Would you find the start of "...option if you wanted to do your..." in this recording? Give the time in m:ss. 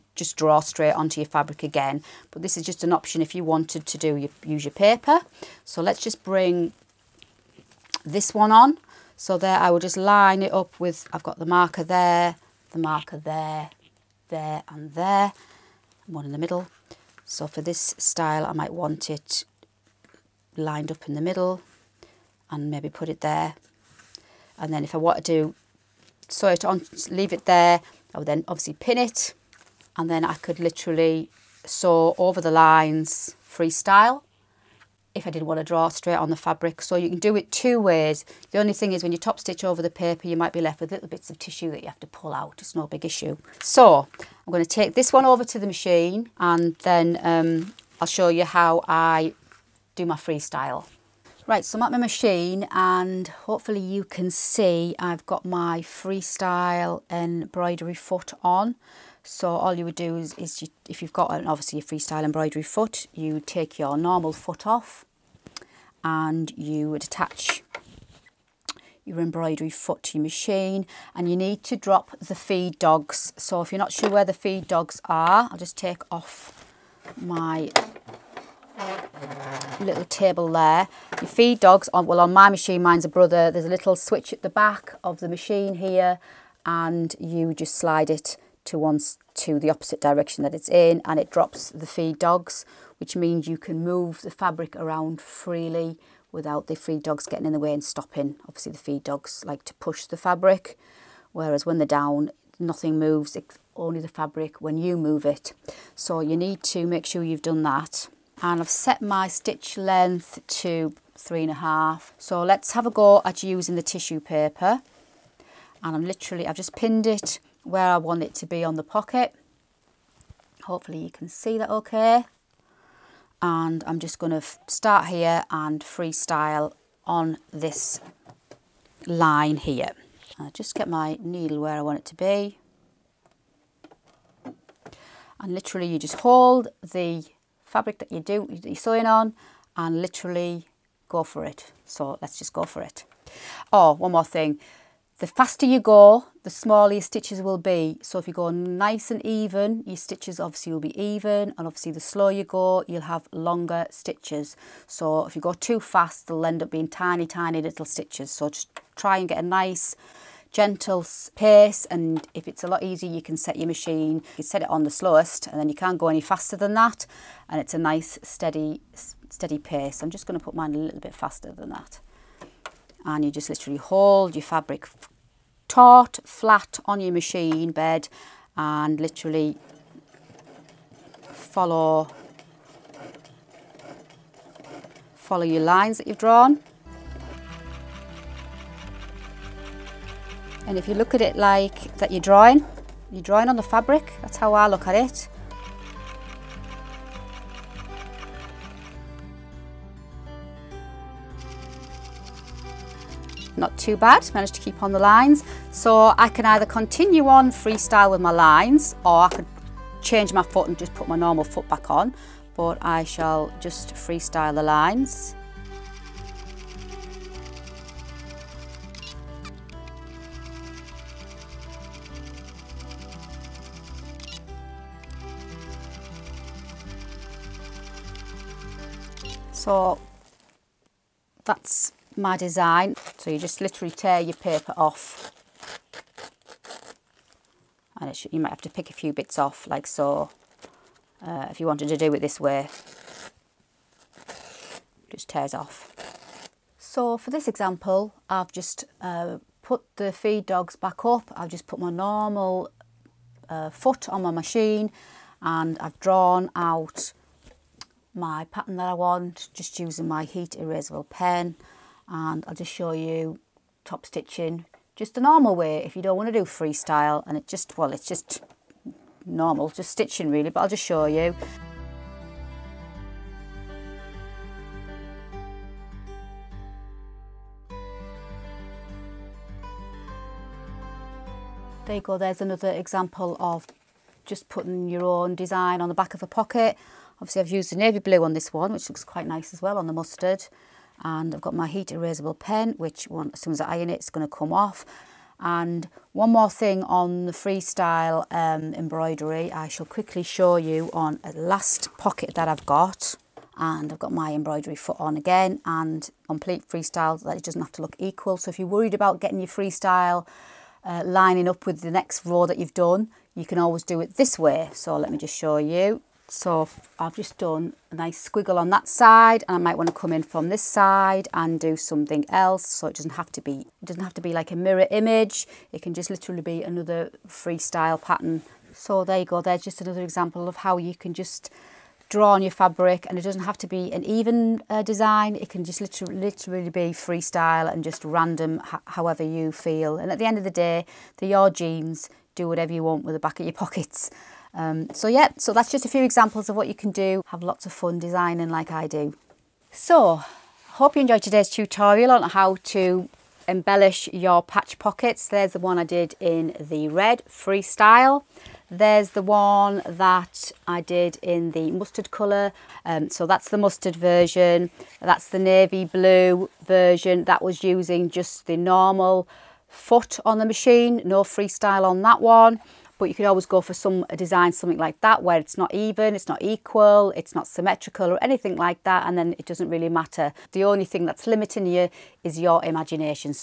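0:02.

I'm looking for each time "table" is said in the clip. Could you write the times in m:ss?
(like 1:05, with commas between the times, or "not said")
1:20.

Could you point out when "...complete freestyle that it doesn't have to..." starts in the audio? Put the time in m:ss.
5:06.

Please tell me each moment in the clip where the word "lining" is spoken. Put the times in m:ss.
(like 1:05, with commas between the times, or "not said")
5:11.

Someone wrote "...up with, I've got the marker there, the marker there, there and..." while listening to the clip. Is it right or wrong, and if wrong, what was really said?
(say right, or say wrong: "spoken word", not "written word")
right.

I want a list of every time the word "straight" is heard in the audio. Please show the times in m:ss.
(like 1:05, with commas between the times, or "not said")
0:00, 0:35.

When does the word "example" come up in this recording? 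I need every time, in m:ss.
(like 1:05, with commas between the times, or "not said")
4:07, 4:42, 5:30, 5:46.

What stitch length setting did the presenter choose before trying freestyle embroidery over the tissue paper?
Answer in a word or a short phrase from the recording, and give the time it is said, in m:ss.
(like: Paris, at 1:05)
3.5, at 1:51.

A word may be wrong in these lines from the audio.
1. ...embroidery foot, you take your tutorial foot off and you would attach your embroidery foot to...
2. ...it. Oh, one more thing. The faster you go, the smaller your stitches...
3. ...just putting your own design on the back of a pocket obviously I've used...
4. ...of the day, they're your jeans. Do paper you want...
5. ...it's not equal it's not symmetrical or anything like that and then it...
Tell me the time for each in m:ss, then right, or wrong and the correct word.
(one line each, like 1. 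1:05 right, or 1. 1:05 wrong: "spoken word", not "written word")
1. 1:02 wrong: "normal", not "tutorial"
2. 2:22 right
3. 4:44 right
4. 5:40 wrong: "whatever", not "paper"
5. 6:16 right.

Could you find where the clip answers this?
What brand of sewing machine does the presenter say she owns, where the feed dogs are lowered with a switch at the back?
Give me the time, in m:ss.
1:23.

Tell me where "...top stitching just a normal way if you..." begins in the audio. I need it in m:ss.
4:23.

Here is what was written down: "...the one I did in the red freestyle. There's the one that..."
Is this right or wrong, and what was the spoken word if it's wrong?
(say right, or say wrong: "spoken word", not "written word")
right.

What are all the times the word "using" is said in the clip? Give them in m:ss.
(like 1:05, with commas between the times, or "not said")
1:53, 4:19, 6:07.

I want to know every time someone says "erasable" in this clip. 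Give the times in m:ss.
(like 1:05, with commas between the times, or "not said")
4:20, 4:51.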